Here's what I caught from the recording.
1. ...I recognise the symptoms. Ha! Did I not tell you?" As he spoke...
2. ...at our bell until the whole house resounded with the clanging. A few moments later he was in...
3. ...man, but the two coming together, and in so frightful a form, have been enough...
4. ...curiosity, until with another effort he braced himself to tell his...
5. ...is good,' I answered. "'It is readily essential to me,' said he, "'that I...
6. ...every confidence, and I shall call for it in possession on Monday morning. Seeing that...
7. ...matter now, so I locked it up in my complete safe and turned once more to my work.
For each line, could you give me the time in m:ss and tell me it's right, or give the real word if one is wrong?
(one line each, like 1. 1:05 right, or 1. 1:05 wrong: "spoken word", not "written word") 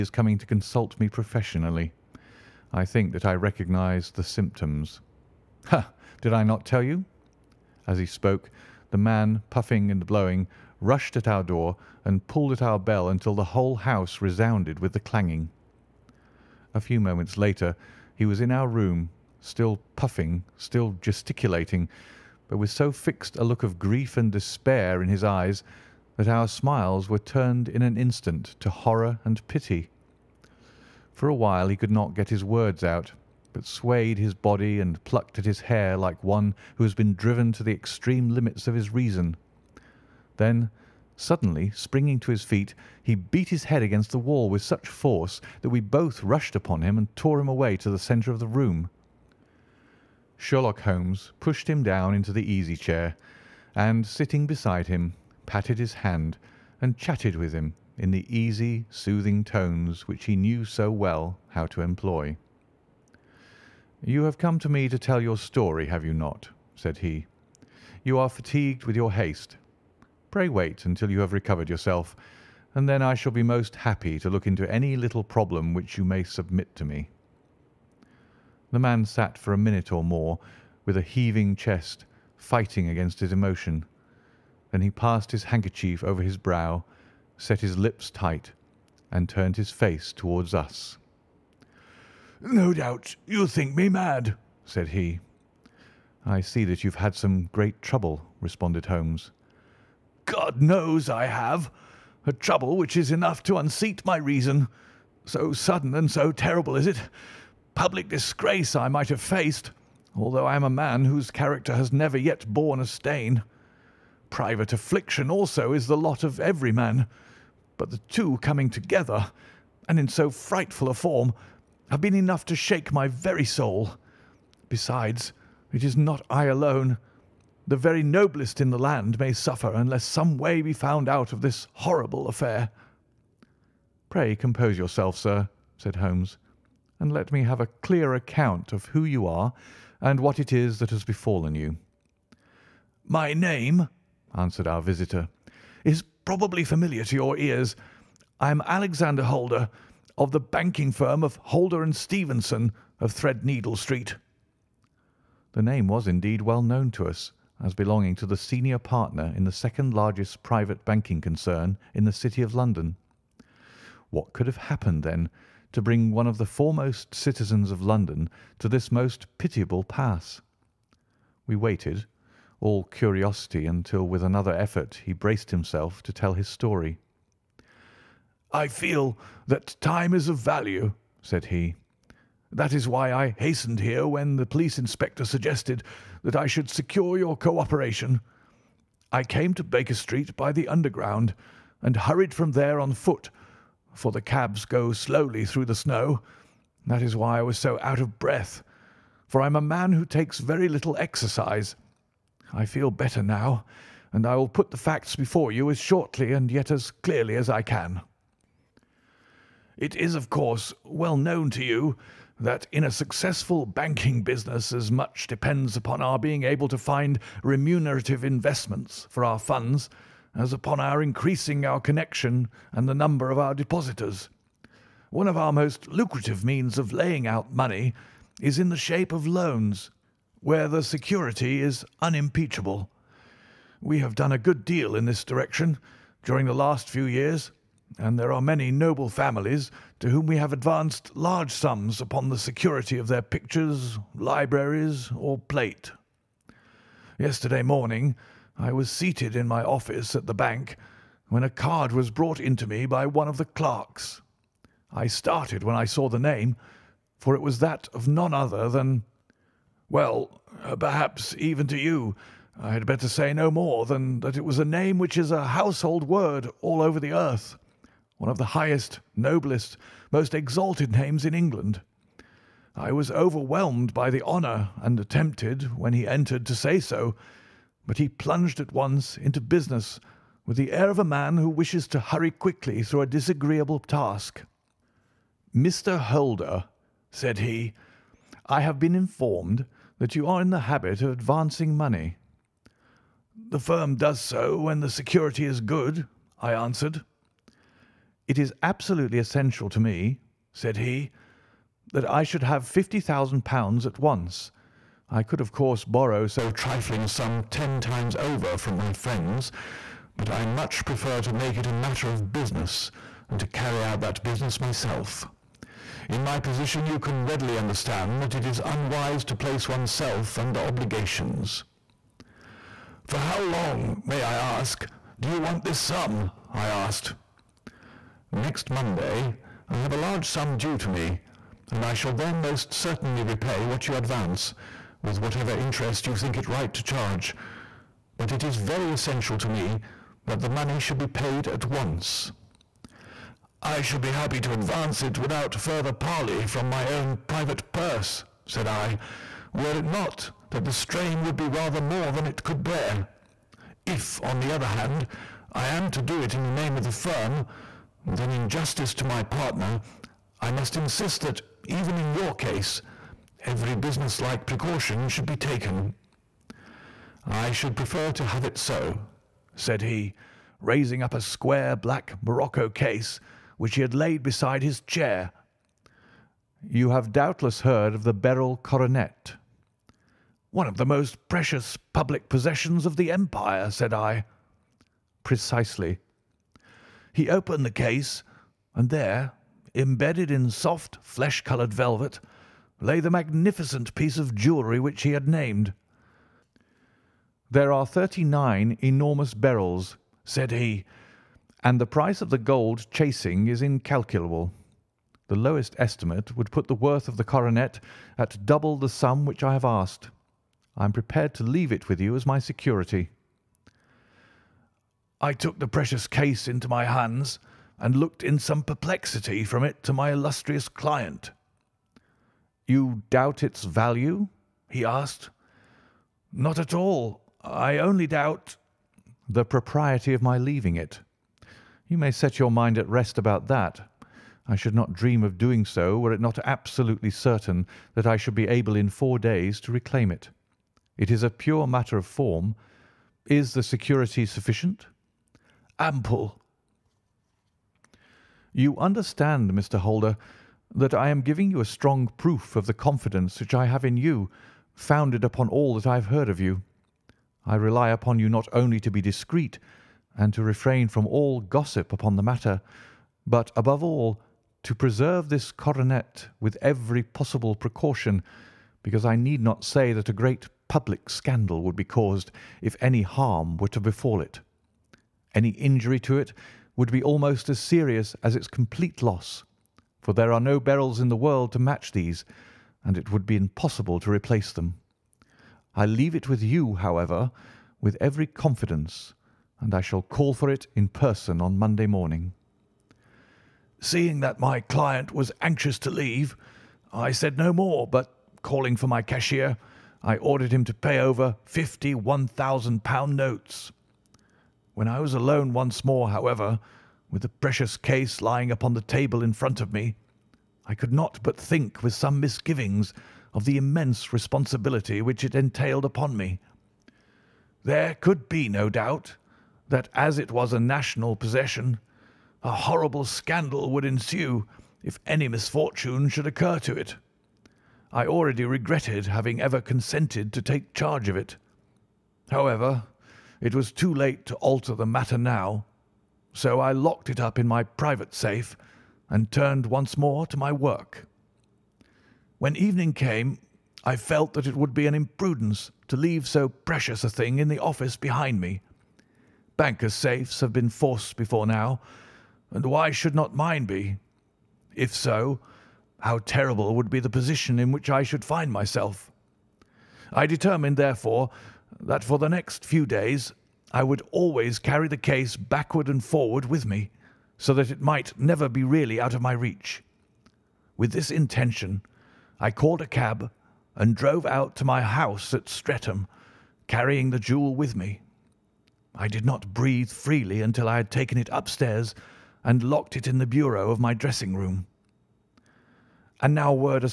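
1. 0:03 right
2. 0:12 right
3. 1:56 right
4. 2:52 right
5. 4:55 wrong: "absolutely", not "readily"
6. 8:08 wrong: "person", not "possession"
7. 8:54 wrong: "private", not "complete".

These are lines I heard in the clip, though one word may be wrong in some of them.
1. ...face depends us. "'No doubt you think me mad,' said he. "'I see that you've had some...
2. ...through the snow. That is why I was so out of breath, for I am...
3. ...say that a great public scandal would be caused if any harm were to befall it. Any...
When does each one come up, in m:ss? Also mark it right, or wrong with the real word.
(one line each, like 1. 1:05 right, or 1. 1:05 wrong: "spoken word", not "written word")
1. 1:29 wrong: "towards", not "depends"
2. 3:15 right
3. 7:49 right.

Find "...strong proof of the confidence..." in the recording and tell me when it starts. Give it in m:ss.
7:31.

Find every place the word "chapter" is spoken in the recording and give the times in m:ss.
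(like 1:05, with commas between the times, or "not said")
not said.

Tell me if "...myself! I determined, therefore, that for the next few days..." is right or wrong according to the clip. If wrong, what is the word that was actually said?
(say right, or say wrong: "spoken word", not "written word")
right.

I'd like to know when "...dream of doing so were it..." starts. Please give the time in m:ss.
7:14.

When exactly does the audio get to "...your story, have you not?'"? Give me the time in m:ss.
1:05.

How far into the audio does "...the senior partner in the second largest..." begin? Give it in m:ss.
2:38.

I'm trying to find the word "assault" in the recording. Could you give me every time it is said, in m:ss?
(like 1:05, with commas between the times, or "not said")
not said.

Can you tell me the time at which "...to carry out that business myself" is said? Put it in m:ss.
5:13.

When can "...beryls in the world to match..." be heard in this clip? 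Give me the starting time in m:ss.
8:00.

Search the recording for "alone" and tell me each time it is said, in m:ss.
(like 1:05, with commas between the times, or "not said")
2:06, 8:25.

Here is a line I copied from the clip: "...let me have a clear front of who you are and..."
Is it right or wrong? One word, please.
wrong.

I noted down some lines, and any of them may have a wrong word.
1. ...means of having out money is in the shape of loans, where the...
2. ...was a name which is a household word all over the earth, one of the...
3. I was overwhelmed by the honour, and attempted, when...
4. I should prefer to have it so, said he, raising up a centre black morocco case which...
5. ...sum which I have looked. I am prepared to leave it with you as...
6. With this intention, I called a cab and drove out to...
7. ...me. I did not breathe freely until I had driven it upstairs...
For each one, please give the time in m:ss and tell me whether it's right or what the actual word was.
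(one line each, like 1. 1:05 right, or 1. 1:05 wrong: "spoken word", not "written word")
1. 3:46 wrong: "laying", not "having"
2. 4:24 right
3. 4:32 right
4. 6:07 wrong: "square", not "centre"
5. 6:48 wrong: "asked", not "looked"
6. 9:30 right
7. 9:37 wrong: "taken", not "driven".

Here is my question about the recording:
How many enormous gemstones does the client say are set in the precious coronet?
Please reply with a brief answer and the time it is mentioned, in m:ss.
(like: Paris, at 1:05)
39, at 6:37.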